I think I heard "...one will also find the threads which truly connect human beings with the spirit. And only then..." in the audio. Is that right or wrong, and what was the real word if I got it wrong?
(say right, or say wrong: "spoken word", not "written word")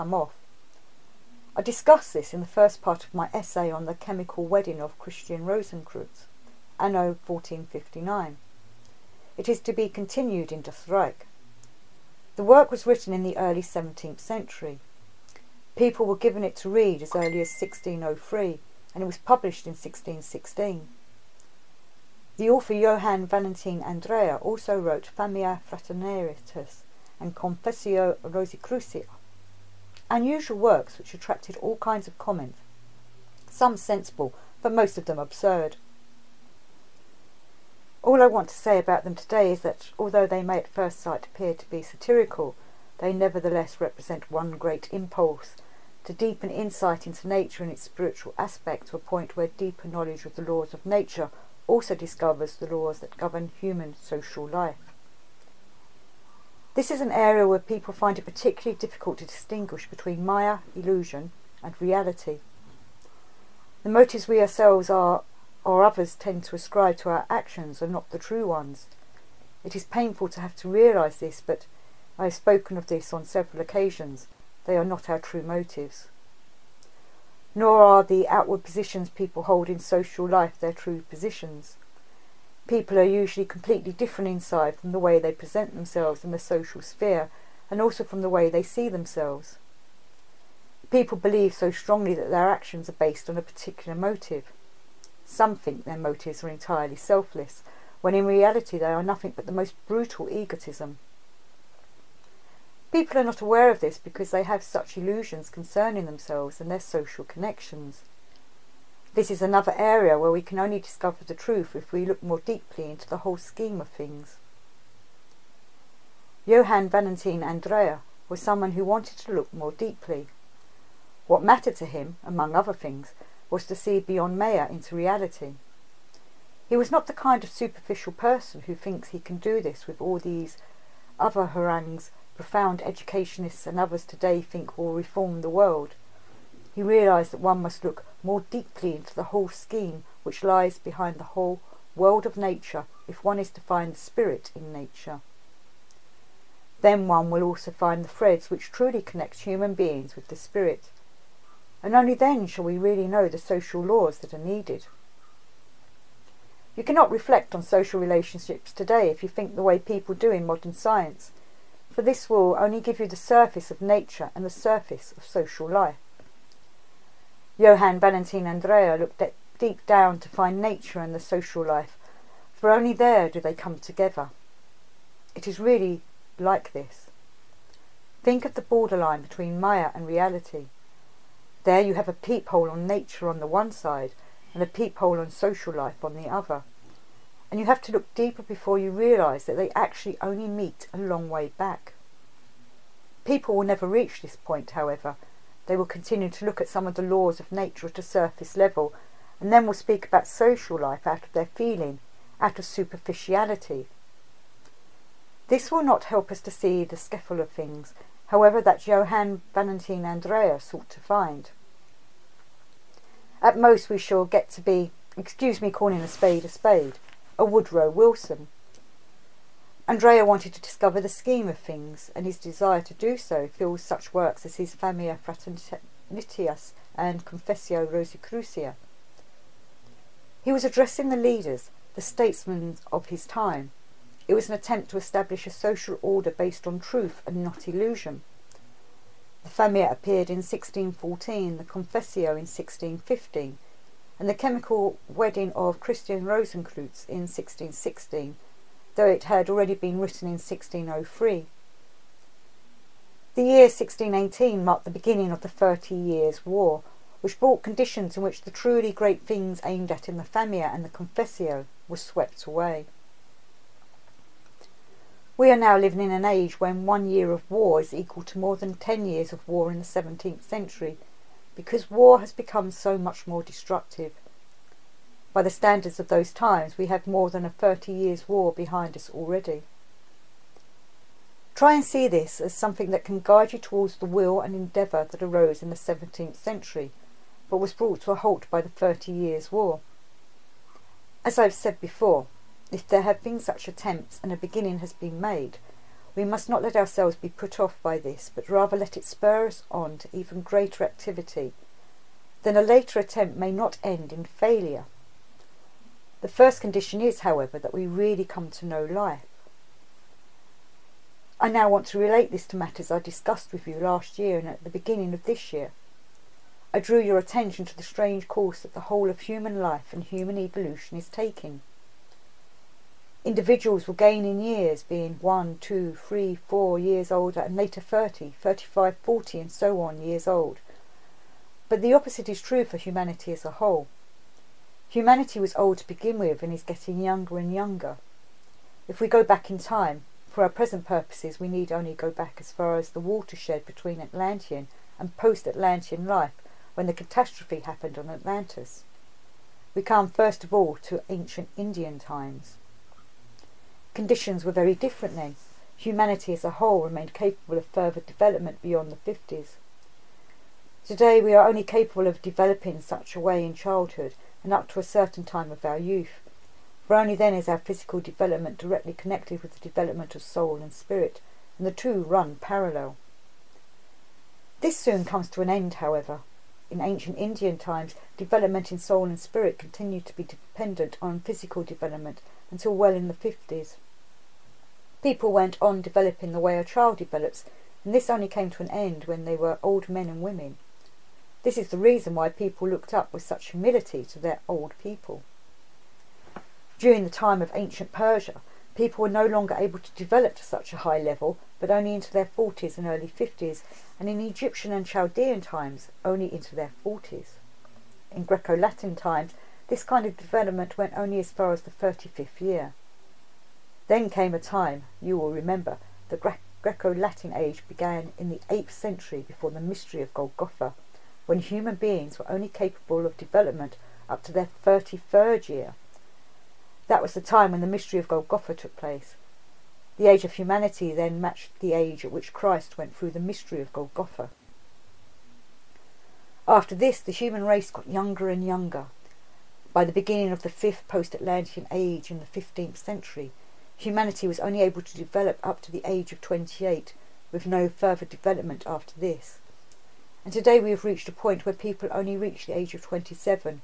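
right.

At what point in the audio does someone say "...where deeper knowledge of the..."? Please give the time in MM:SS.
00:49.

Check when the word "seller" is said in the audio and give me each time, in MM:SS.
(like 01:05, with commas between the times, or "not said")
not said.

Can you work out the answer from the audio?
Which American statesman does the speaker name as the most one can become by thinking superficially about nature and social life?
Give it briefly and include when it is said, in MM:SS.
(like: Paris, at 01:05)
Woodrow Wilson, at 03:37.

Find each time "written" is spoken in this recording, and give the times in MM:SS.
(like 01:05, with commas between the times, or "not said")
00:12, 04:09.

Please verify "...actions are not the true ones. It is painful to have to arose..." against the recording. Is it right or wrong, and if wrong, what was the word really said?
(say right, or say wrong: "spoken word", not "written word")
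wrong: "realise", not "arose".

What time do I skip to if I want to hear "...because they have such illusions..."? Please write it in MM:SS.
01:43.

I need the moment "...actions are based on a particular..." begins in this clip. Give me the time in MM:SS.
01:32.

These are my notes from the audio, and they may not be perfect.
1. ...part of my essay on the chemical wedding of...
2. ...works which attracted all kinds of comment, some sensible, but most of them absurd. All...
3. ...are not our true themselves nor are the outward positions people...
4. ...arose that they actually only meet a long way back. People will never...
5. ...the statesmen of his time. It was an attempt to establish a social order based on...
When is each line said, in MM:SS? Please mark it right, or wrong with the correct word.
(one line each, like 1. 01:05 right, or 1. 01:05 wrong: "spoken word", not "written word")
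1. 00:02 right
2. 00:30 right
3. 01:14 wrong: "motives", not "themselves"
4. 03:08 wrong: "realise", not "arose"
5. 03:51 right.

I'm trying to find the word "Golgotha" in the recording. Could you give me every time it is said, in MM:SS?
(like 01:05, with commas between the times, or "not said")
07:00, 07:08, 07:13.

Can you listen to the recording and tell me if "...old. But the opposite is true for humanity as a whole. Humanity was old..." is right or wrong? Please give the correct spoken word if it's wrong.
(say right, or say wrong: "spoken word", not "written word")
right.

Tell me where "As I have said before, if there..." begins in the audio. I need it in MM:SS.
04:51.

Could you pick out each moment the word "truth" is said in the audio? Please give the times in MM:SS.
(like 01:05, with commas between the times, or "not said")
01:51, 03:56.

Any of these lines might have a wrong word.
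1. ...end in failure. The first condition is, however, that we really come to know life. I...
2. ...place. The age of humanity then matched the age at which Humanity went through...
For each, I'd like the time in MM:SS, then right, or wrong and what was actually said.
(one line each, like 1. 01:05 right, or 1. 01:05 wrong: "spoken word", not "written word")
1. 05:03 right
2. 07:08 wrong: "Christ", not "Humanity".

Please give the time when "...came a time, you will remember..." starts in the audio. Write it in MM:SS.
06:54.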